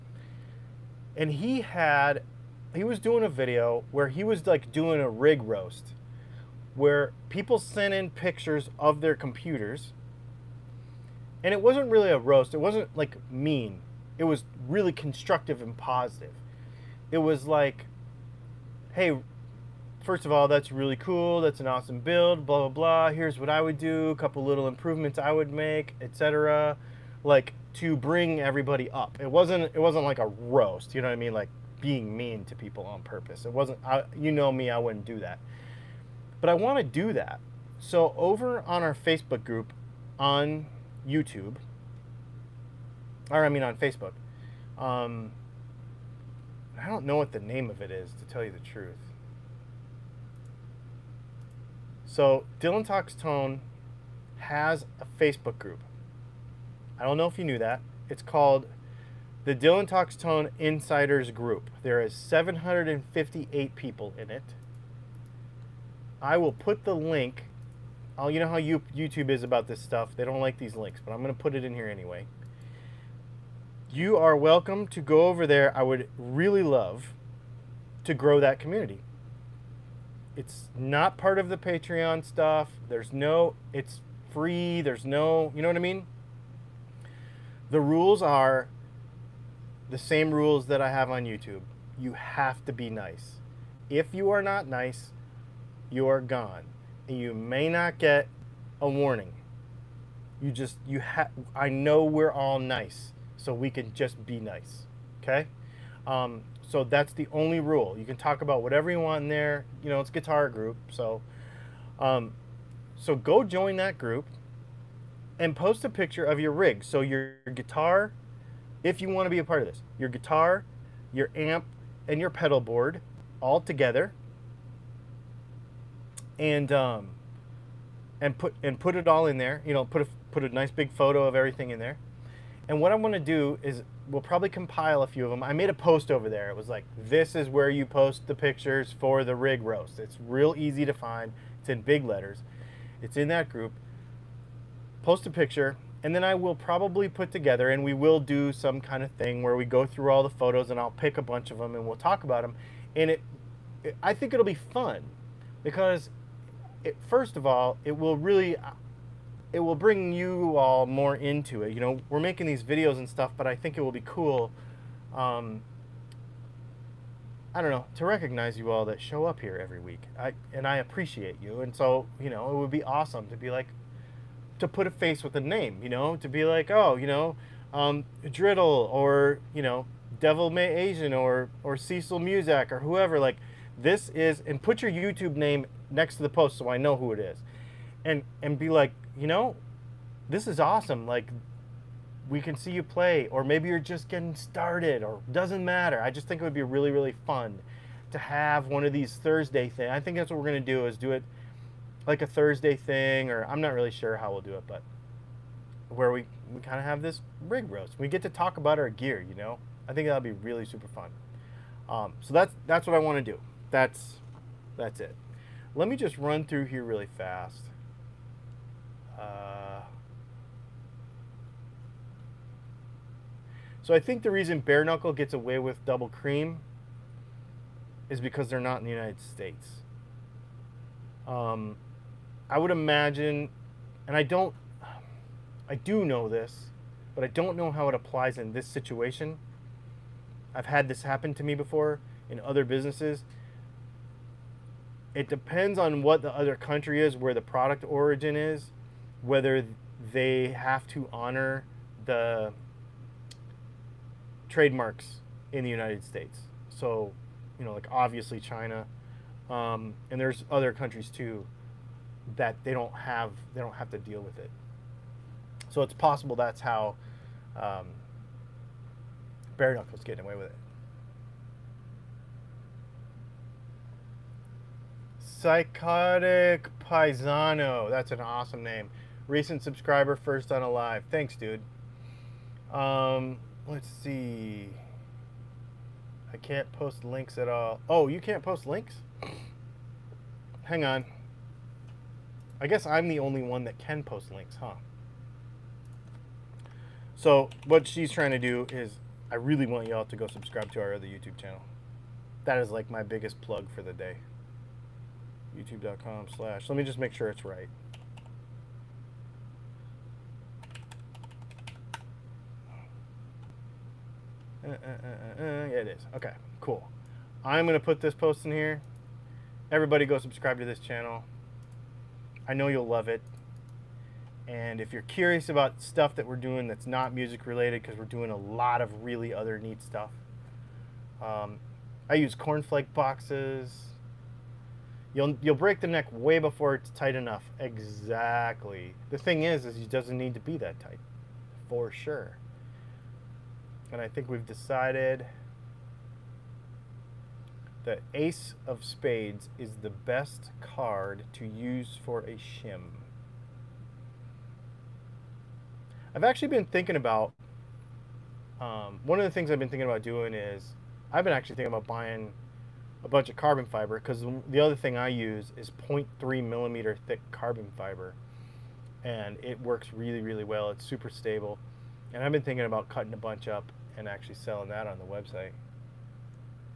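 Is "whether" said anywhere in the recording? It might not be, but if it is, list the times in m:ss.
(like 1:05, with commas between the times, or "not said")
4:09.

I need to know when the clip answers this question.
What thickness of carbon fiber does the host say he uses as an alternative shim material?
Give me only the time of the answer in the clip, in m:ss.
6:05.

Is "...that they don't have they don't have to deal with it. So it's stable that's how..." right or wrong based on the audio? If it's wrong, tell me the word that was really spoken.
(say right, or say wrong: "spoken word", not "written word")
wrong: "possible", not "stable".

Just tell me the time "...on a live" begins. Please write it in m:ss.
4:40.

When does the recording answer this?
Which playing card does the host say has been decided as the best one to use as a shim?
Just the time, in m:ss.
5:48.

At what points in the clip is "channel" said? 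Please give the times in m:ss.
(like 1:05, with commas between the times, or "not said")
5:01, 5:20.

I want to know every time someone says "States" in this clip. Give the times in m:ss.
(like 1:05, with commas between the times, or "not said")
3:49, 4:16.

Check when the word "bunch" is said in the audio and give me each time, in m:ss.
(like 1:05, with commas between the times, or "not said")
2:31, 6:03, 6:13.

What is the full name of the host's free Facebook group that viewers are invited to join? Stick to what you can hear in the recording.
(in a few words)
Dylan Talks Tone Insiders Group.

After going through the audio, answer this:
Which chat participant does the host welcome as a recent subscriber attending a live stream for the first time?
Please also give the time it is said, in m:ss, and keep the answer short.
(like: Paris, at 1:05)
Psychotic Paisano, at 4:35.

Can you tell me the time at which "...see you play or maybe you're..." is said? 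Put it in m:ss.
3:12.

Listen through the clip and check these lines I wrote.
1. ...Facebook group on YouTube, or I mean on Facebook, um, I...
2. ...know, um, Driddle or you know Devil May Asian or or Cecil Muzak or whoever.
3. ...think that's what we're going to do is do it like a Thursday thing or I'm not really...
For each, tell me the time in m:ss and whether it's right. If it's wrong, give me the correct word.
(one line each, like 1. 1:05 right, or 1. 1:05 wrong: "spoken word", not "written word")
1. 0:38 right
2. 2:57 right
3. 3:20 right.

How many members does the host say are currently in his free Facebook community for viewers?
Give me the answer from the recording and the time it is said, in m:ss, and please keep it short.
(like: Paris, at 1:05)
758, at 1:02.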